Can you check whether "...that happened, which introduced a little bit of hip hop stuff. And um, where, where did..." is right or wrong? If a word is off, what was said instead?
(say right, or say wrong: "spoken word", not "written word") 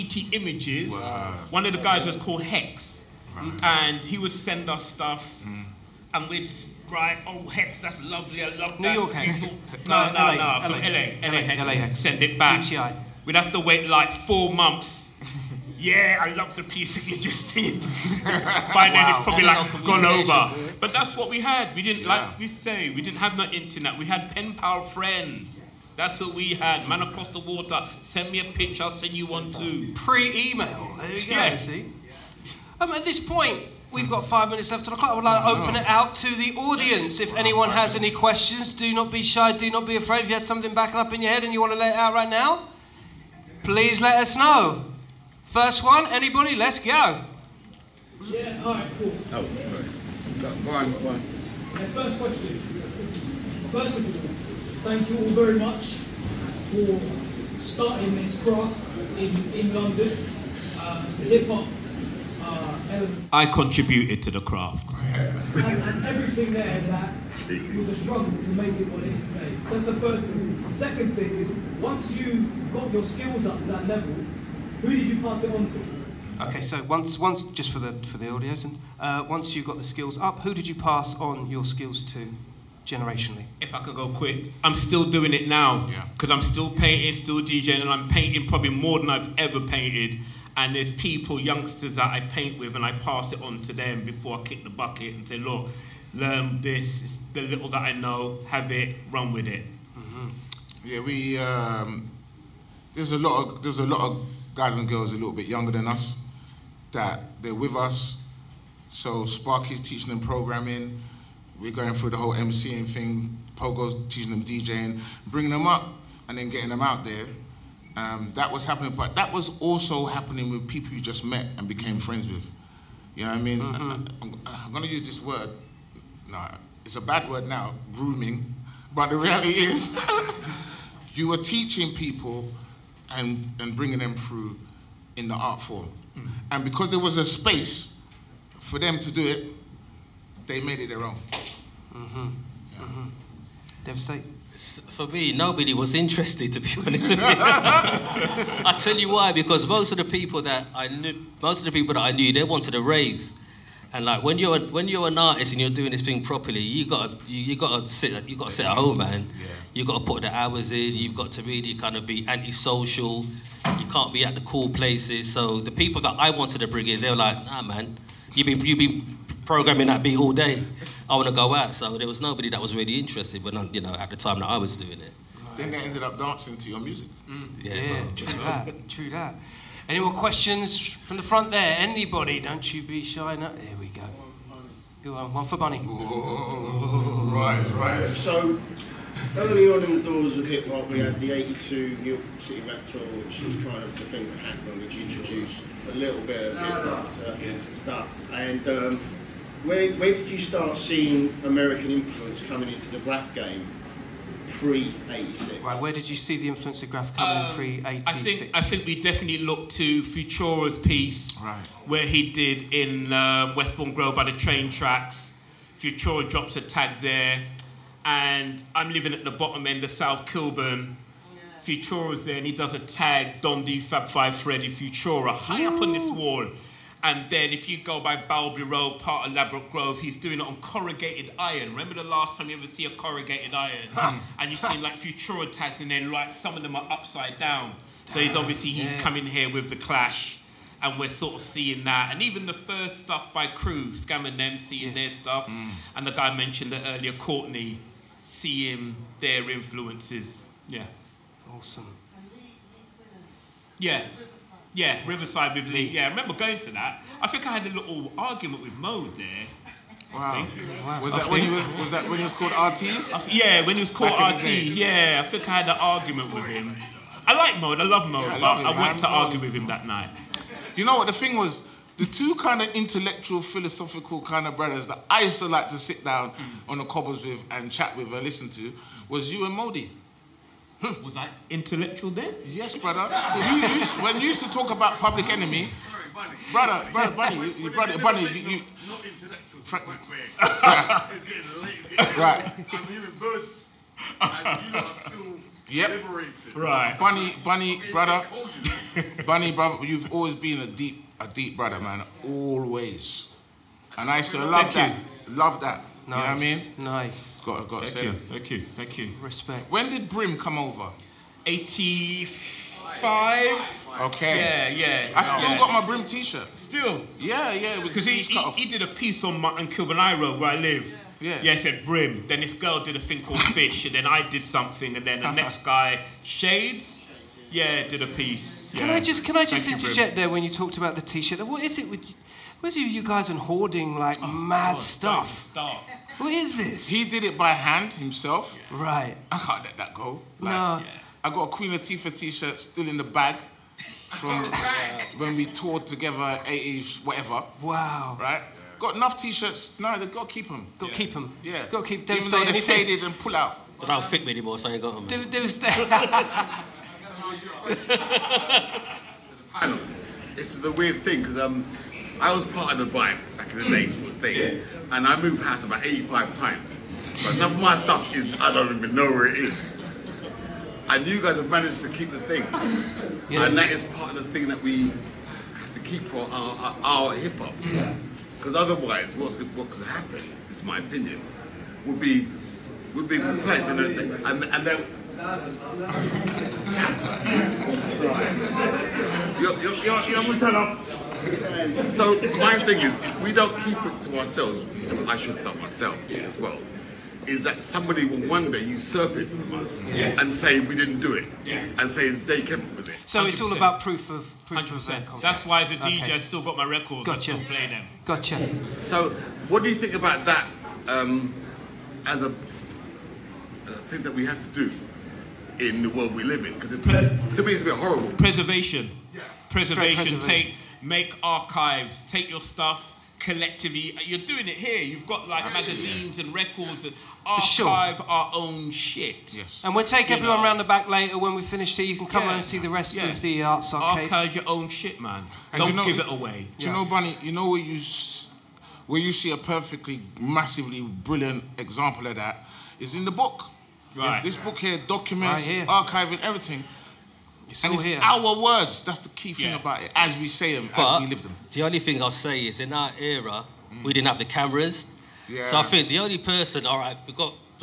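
right.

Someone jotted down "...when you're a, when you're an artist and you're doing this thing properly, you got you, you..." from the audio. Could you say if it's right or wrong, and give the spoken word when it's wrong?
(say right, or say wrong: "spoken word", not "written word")
right.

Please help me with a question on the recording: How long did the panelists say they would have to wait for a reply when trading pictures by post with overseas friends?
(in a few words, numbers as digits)
4 months.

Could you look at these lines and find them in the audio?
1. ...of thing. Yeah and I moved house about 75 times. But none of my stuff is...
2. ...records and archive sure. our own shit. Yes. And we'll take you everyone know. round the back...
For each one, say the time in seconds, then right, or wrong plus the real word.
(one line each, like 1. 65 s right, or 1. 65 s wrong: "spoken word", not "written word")
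1. 364 s wrong: "85", not "75"
2. 426 s right.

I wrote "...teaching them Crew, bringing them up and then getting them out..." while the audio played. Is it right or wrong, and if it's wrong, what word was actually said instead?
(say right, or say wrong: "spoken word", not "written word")
wrong: "DJing", not "Crew".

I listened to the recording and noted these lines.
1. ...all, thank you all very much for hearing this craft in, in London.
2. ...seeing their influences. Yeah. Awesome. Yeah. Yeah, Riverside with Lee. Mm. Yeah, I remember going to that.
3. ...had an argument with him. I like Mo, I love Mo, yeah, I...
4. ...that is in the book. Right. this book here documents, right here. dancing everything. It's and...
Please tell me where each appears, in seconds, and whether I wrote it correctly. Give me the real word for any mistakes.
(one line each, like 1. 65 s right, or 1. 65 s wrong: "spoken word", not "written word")
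1. 54 s wrong: "starting", not "hearing"
2. 248 s right
3. 265 s right
4. 442 s wrong: "archiving", not "dancing".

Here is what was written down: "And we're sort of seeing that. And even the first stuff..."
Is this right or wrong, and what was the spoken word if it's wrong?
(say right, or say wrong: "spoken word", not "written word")
right.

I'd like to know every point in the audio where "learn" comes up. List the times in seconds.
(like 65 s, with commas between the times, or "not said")
96 s.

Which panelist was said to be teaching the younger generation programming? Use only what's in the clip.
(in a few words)
Sparky.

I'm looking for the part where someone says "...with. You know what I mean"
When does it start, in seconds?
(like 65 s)
122 s.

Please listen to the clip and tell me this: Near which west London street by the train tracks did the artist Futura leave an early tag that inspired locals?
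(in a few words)
Westbourne Grove.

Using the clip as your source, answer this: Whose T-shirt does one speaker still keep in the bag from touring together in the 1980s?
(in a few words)
Queen Latifah.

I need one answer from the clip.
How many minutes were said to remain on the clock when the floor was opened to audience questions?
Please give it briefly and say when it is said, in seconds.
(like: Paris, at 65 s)
5, at 34 s.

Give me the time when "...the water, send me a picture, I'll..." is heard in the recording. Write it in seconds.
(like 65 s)
27 s.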